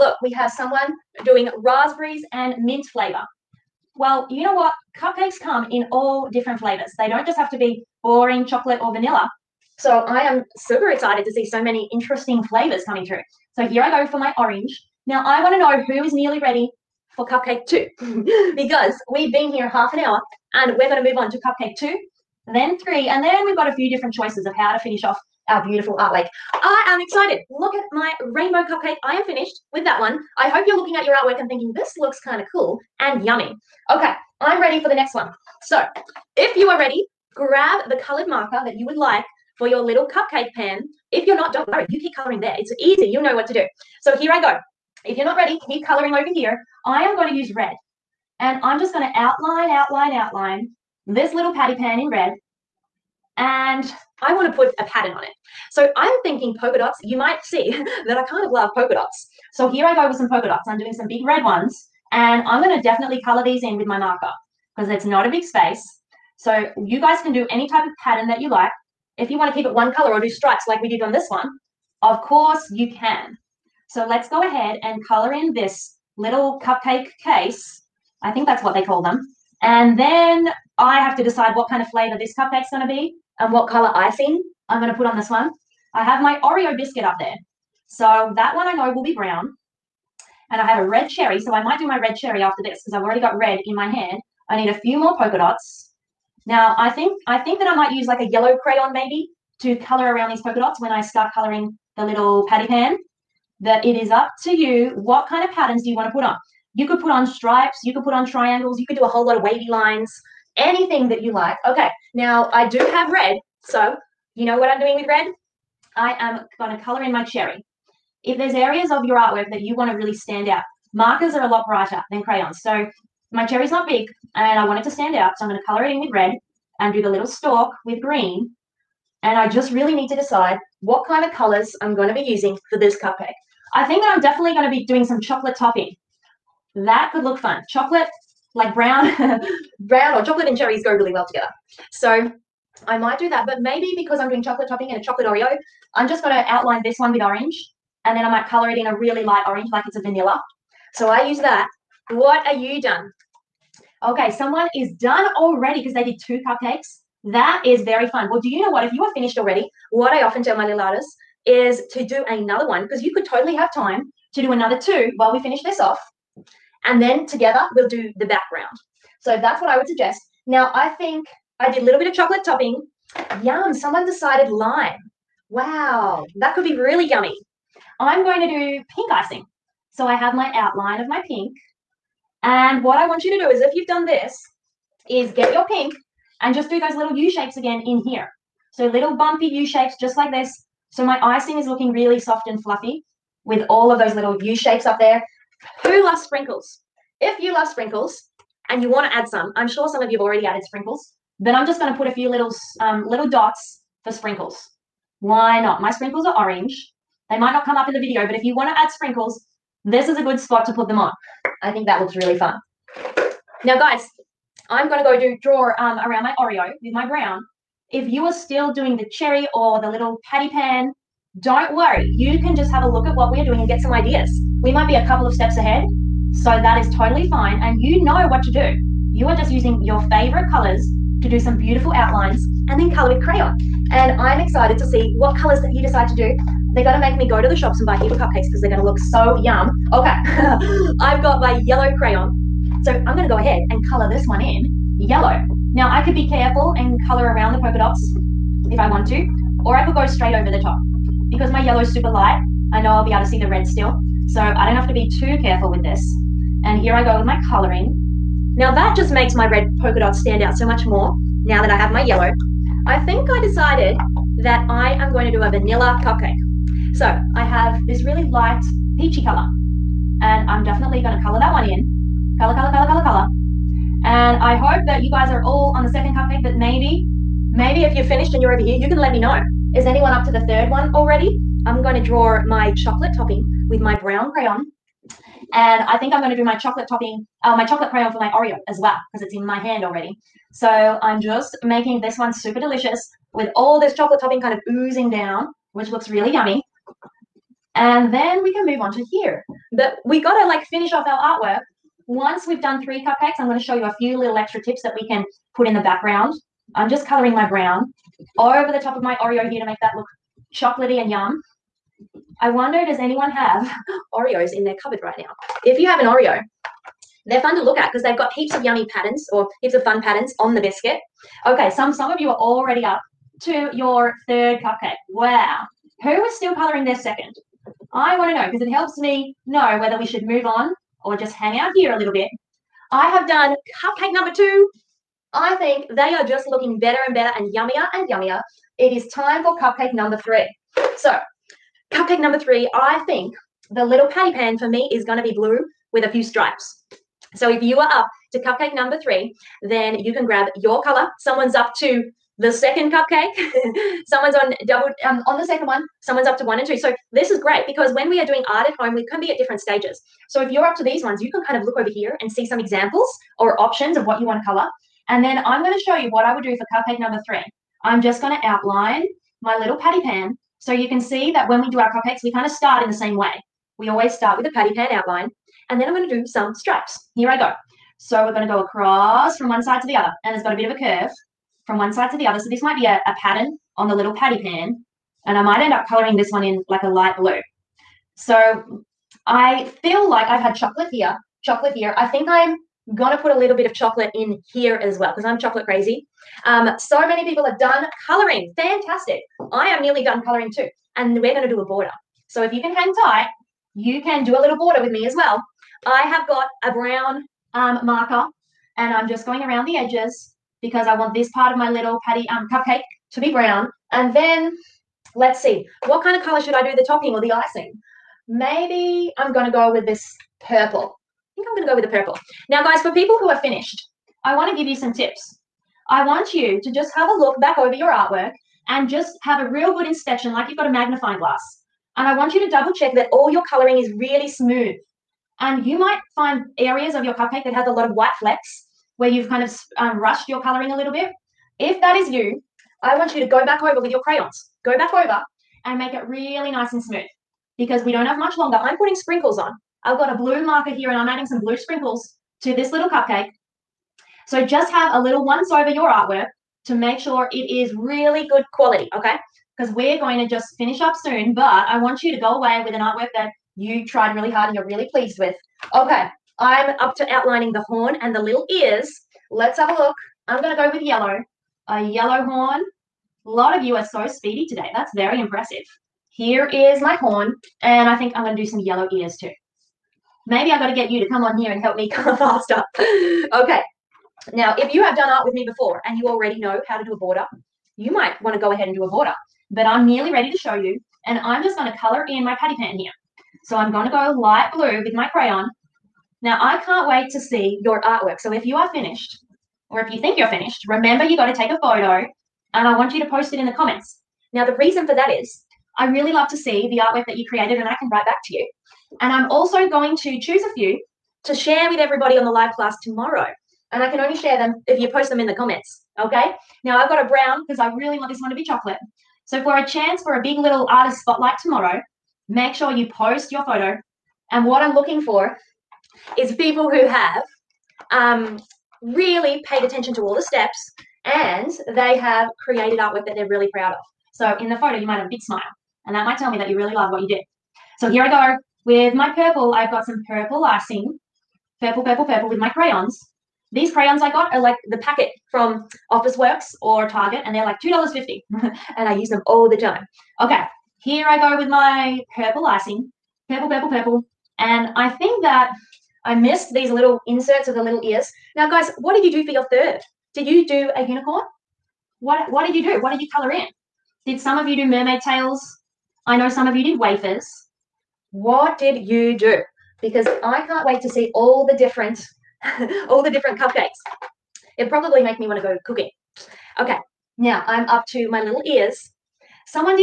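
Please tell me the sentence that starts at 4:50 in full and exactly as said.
So I'm just making this one super delicious with all this chocolate topping kind of oozing down, which looks really yummy.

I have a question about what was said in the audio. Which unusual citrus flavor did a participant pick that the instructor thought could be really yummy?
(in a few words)
lime.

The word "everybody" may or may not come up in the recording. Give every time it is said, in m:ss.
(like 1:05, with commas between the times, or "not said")
8:31.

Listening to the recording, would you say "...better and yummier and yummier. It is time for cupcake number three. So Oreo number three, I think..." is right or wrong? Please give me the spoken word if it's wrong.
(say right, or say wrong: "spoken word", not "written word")
wrong: "Cupcake", not "Oreo".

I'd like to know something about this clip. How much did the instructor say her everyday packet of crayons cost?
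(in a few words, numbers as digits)
$2.50.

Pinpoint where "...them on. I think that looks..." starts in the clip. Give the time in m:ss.
3:30.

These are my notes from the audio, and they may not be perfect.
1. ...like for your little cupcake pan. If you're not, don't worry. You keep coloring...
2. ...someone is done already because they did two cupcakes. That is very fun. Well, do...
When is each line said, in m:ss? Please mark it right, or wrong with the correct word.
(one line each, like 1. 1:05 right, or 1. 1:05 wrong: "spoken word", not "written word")
1. 0:38 right
2. 2:34 right.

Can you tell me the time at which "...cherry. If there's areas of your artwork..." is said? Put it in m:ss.
1:57.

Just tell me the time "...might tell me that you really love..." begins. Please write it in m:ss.
8:56.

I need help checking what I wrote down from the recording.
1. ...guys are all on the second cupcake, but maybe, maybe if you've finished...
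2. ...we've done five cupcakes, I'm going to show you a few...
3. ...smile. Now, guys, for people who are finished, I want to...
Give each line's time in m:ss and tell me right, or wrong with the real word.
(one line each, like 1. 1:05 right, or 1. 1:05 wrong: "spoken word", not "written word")
1. 4:35 right
2. 5:02 wrong: "three", not "five"
3. 7:01 wrong: "purple", not "smile".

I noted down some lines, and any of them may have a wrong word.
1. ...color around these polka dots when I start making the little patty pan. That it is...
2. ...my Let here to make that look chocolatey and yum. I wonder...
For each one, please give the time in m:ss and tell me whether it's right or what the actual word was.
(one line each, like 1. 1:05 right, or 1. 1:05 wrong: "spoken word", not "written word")
1. 1:39 wrong: "coloring", not "making"
2. 5:09 wrong: "Oreo", not "Let".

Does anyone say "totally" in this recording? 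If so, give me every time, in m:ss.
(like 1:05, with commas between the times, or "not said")
2:43, 3:46.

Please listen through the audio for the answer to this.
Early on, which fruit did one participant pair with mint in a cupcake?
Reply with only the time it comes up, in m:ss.
0:01.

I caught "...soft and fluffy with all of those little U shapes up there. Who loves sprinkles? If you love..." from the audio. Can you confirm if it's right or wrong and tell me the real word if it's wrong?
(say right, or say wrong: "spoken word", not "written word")
right.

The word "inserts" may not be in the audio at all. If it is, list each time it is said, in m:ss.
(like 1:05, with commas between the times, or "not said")
9:17.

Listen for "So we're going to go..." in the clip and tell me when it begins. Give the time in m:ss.
6:18.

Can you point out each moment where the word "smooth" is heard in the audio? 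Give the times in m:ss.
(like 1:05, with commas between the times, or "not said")
7:14, 7:26.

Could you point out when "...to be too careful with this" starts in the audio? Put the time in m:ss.
4:14.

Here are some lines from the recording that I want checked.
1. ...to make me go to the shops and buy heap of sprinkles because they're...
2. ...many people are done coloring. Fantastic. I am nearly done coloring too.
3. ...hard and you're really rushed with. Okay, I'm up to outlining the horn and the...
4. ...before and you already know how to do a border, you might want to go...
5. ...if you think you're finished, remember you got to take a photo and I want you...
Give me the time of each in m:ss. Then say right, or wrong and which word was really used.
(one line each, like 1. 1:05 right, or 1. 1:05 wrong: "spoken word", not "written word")
1. 3:56 wrong: "cupcakes", not "sprinkles"
2. 6:37 right
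3. 7:44 wrong: "pleased", not "rushed"
4. 8:05 right
5. 8:19 right.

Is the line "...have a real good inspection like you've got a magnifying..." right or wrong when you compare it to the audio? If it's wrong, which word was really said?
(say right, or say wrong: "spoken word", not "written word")
right.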